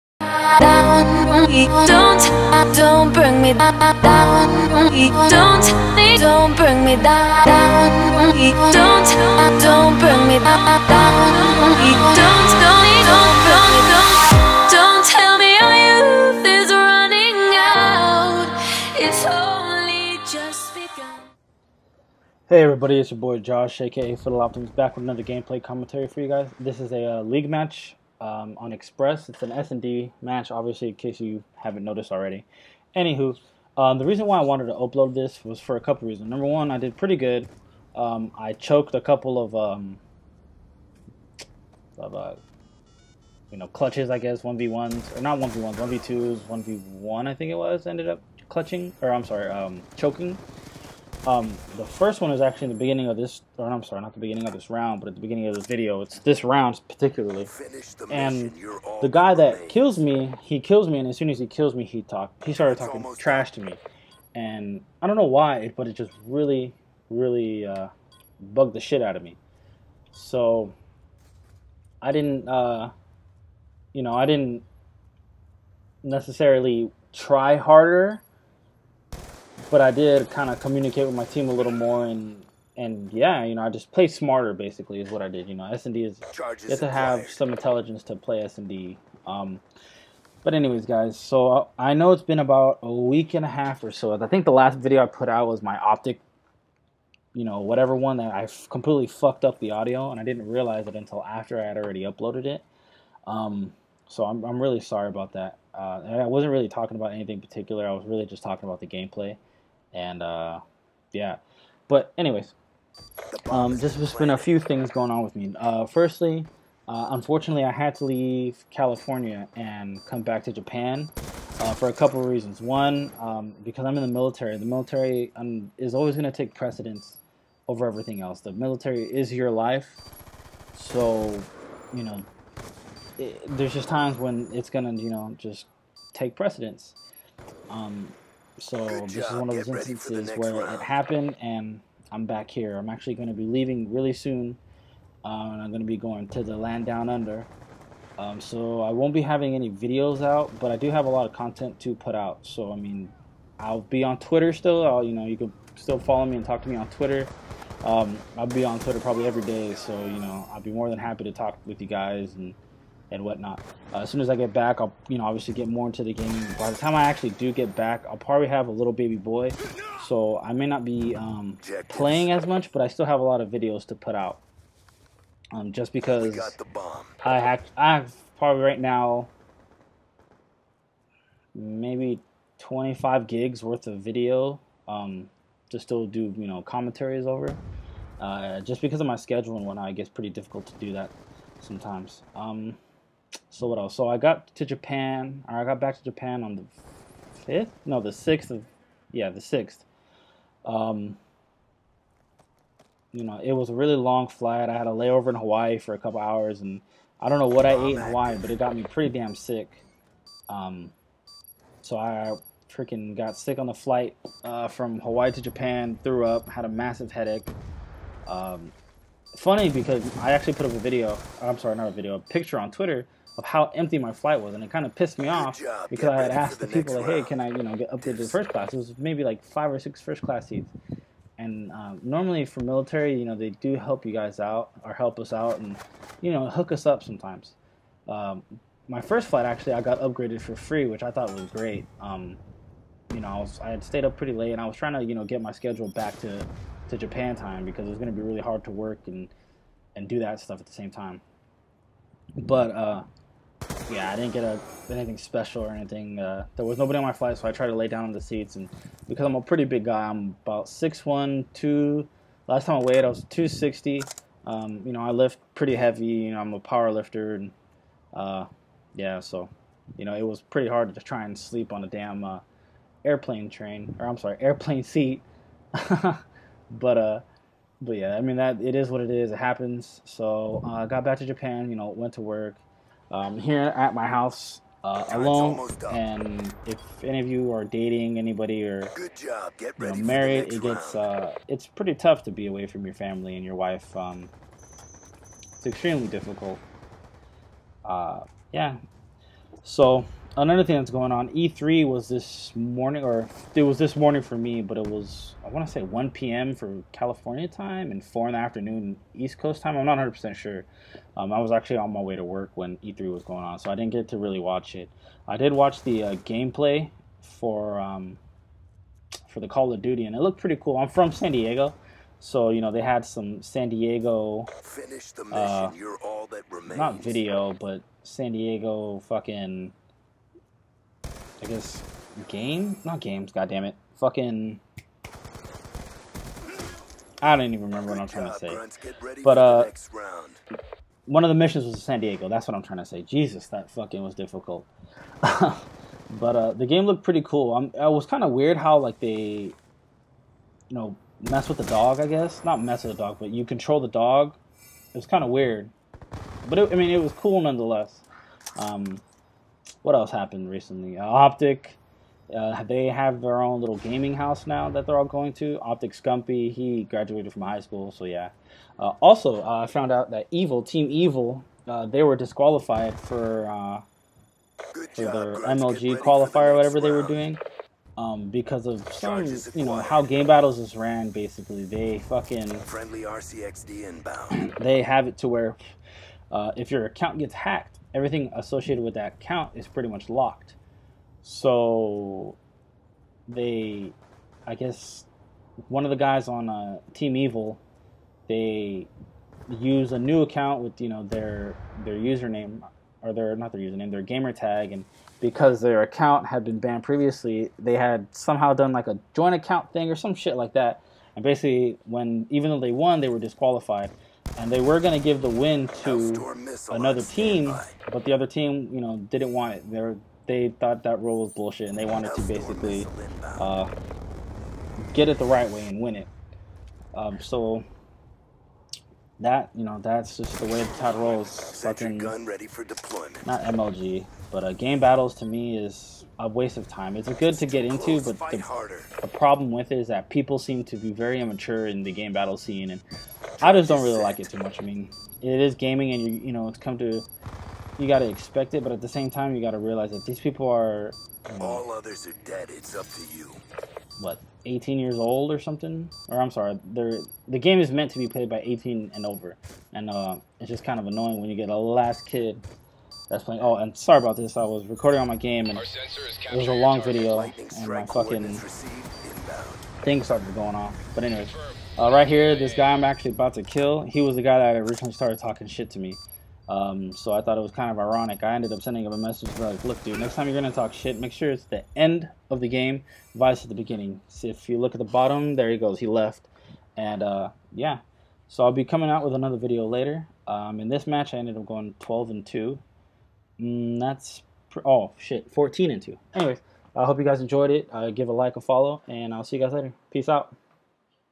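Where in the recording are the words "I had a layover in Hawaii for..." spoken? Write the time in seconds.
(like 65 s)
204 s.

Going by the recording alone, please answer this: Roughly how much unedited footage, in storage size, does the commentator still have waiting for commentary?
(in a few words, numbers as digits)
25 gigs.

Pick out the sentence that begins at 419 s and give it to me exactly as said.
They they thought that rule was bullshit, and they wanted to basically uh, get it the right way and win it.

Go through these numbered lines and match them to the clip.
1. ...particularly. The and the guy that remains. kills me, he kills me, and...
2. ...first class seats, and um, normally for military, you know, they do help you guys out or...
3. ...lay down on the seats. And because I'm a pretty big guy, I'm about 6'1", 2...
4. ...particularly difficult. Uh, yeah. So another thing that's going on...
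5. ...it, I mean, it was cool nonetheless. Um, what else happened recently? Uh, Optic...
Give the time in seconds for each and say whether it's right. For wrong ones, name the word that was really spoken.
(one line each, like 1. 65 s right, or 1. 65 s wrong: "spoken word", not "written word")
1. 56 s right
2. 230 s right
3. 257 s right
4. 295 s wrong: "extremely", not "particularly"
5. 356 s right.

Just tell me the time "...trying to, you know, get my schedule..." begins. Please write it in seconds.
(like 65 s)
244 s.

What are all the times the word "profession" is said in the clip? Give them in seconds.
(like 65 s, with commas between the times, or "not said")
not said.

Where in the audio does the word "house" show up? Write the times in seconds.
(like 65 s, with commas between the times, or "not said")
284 s, 364 s.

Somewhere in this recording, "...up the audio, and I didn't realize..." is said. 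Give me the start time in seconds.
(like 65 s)
99 s.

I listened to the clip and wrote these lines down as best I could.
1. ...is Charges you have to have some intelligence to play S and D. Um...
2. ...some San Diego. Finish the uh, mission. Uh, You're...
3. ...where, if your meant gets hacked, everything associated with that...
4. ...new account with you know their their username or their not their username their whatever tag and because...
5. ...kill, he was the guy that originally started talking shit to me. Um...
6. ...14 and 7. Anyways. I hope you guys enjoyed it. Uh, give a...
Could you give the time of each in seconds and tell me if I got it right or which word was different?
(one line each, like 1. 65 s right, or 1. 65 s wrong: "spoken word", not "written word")
1. 86 s right
2. 323 s right
3. 385 s wrong: "account", not "meant"
4. 399 s wrong: "gamer", not "whatever"
5. 473 s right
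6. 495 s wrong: "2", not "7".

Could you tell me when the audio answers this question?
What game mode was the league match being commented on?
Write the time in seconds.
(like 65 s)
29 s.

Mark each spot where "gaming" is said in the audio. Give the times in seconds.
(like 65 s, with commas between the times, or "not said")
363 s, 445 s.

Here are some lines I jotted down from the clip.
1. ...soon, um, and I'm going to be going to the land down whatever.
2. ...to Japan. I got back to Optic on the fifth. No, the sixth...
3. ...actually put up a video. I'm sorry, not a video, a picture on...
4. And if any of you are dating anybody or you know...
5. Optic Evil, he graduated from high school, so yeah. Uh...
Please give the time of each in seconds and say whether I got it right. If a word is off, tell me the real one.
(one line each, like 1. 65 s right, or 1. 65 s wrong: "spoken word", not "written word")
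1. 144 s wrong: "under", not "whatever"
2. 194 s wrong: "Japan", not "Optic"
3. 220 s right
4. 285 s right
5. 365 s wrong: "Scumpy", not "Evil".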